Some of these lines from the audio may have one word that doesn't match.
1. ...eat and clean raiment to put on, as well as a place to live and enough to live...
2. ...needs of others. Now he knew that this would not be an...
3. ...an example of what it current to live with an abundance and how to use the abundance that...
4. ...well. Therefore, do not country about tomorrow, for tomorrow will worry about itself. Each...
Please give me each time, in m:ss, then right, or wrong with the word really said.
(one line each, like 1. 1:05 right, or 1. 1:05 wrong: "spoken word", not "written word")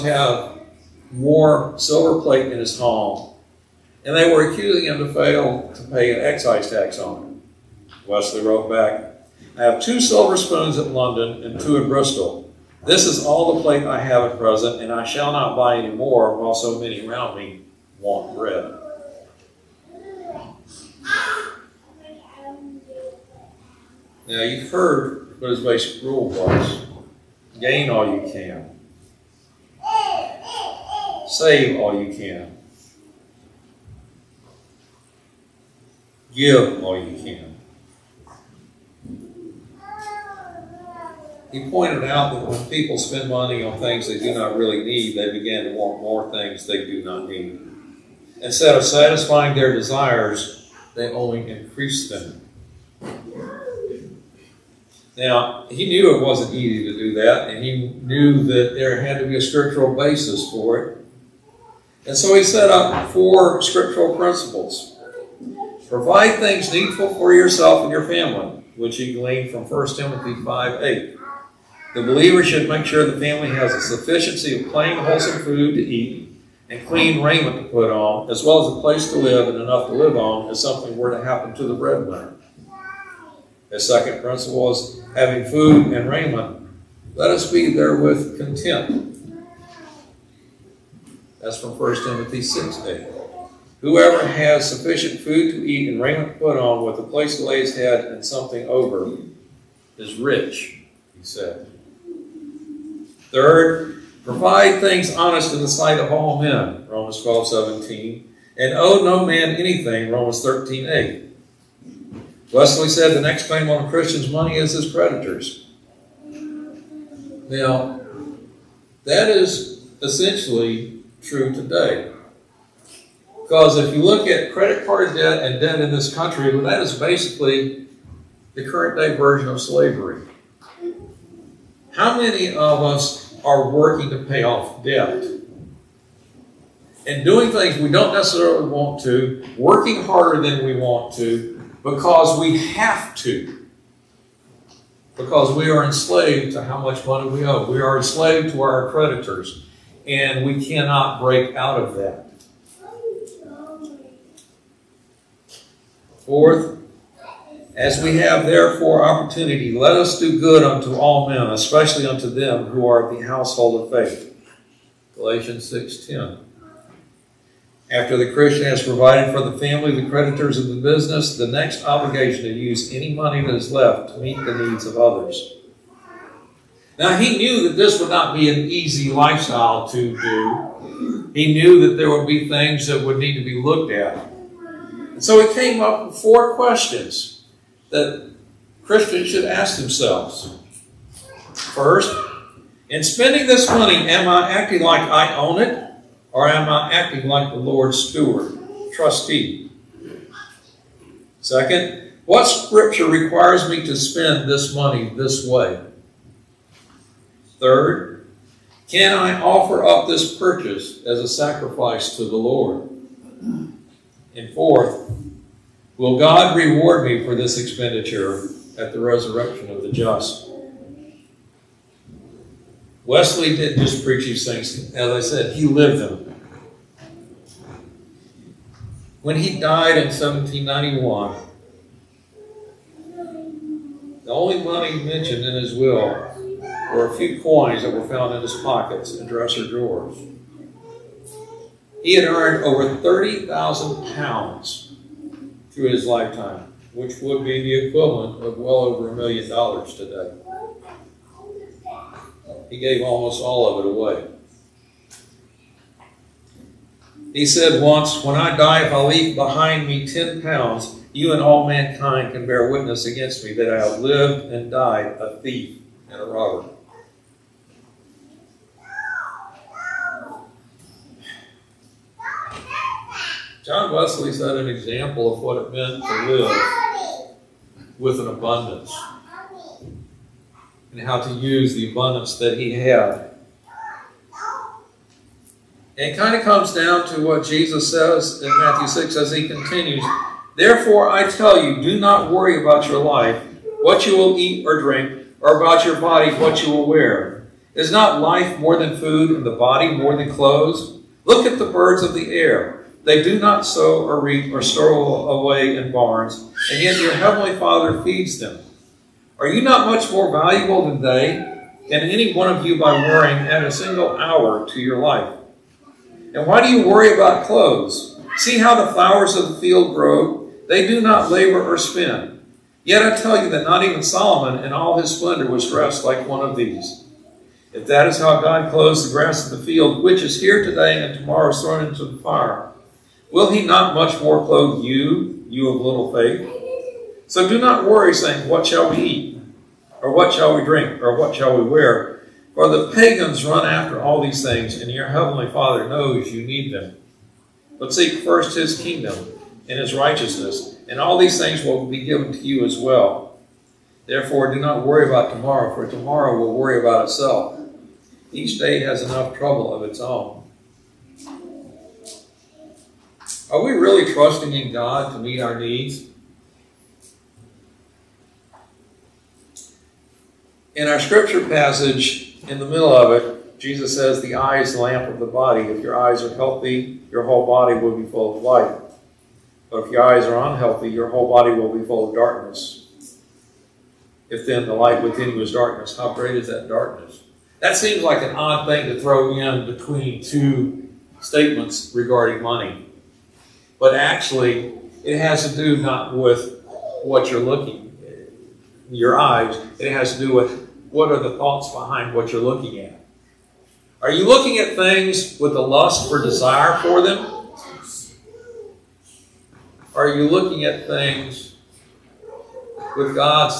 1. 1:15 right
2. 2:54 right
3. 4:34 wrong: "meant", not "current"
4. 5:52 wrong: "worry", not "country".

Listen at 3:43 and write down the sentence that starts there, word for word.
Wesley didn't just preach these things, as I said, he lived them.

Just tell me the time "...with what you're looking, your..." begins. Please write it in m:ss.
6:36.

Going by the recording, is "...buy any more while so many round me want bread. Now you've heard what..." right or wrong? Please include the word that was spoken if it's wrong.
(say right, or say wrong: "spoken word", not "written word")
right.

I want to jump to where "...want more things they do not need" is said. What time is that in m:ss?
0:45.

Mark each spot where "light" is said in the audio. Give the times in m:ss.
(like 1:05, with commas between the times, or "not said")
6:18, 6:24.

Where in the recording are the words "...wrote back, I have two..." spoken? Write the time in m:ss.
0:08.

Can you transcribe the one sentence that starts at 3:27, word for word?
Third, can I offer up this purchase as a sacrifice to the Lord?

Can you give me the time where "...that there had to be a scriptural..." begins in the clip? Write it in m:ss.
0:58.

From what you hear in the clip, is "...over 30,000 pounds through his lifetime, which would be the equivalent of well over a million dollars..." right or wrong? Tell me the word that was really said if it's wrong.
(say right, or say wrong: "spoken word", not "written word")
right.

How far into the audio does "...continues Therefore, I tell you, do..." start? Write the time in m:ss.
4:49.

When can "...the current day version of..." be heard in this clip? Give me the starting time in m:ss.
2:08.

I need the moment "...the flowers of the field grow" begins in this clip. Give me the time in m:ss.
5:18.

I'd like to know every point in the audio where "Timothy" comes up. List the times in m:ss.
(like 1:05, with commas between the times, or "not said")
1:09, 1:32.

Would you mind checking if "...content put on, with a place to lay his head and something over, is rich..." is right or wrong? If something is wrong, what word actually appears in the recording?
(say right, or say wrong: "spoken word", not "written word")
wrong: "raiment", not "content".